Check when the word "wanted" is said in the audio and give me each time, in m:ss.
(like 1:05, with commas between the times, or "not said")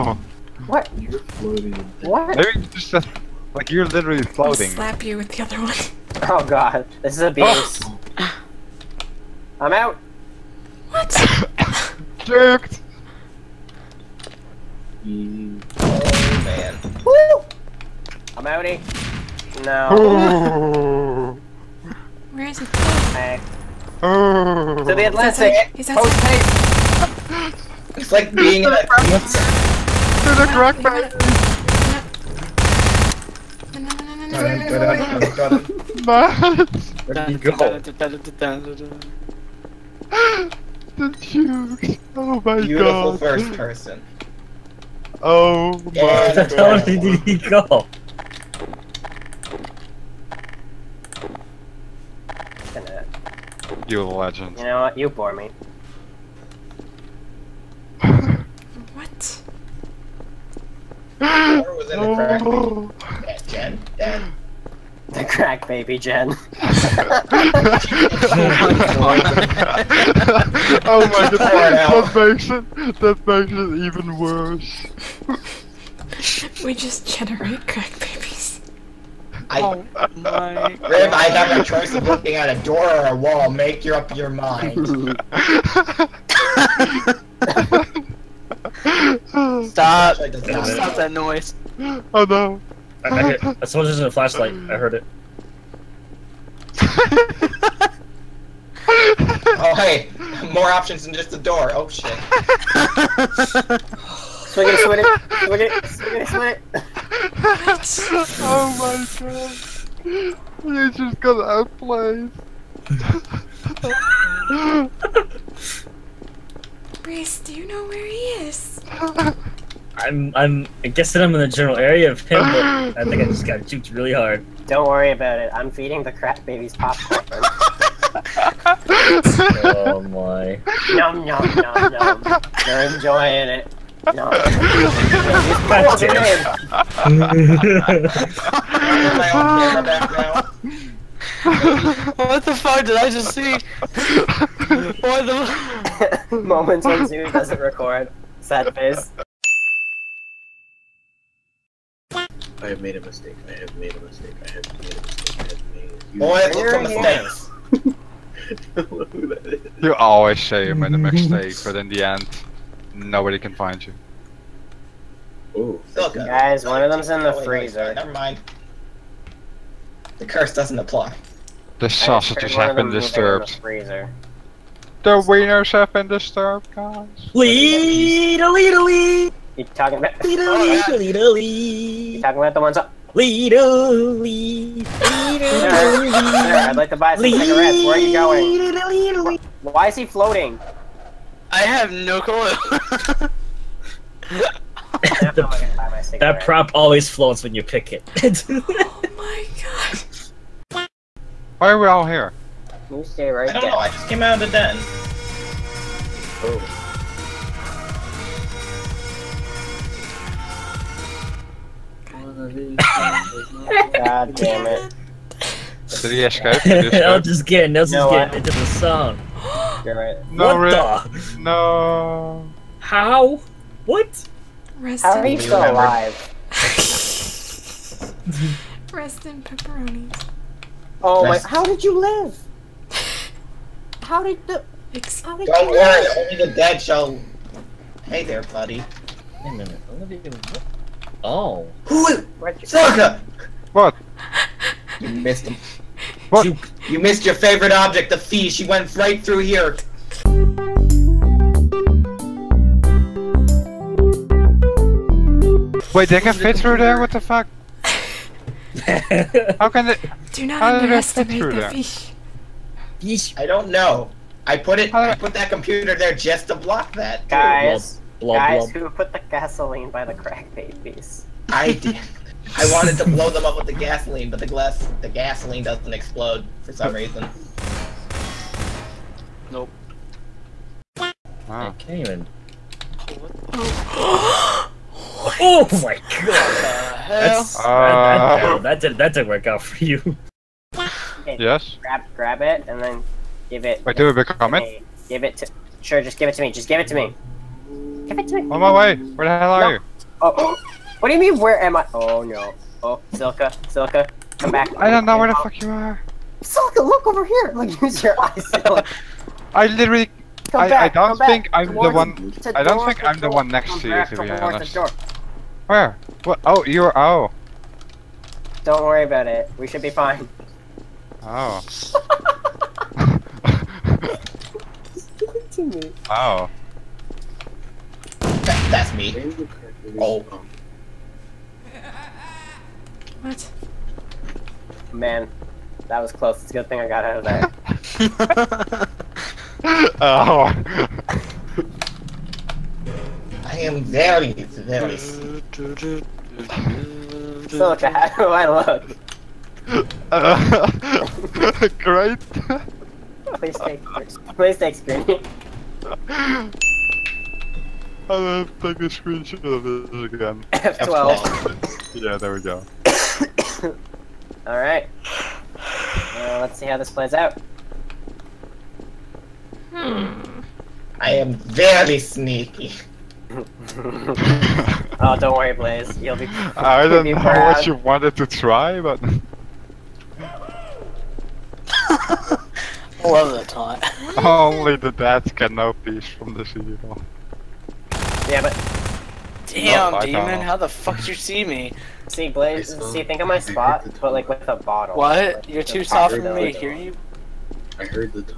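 4:32, 6:17.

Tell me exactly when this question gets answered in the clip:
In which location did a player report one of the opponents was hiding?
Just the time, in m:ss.
2:47.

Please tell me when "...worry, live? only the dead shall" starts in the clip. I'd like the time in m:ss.
3:55.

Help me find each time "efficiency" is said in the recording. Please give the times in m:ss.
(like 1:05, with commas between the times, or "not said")
not said.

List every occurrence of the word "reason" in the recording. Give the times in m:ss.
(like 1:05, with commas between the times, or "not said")
4:36.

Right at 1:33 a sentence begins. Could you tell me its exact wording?
I, I hear, someone's using a flashlight.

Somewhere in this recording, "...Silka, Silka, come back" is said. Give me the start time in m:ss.
5:03.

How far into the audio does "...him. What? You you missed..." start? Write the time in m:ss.
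4:05.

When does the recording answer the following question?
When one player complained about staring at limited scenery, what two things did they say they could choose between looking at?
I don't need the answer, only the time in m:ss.
1:22.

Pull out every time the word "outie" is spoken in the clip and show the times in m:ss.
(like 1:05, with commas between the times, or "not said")
0:18.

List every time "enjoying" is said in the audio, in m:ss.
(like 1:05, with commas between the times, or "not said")
2:12.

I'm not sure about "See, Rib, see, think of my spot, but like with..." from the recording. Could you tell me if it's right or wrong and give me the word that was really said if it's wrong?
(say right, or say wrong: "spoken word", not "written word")
wrong: "Blaze", not "Rib".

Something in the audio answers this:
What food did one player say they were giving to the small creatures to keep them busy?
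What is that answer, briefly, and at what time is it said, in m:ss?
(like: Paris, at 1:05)
Popcorn, at 2:06.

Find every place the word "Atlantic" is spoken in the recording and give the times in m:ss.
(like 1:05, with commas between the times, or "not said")
0:25.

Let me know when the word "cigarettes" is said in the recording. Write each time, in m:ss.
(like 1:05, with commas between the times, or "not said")
3:07.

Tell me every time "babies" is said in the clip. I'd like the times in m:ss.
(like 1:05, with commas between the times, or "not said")
2:06, 4:30.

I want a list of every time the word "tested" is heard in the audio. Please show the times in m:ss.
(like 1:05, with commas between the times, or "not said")
not said.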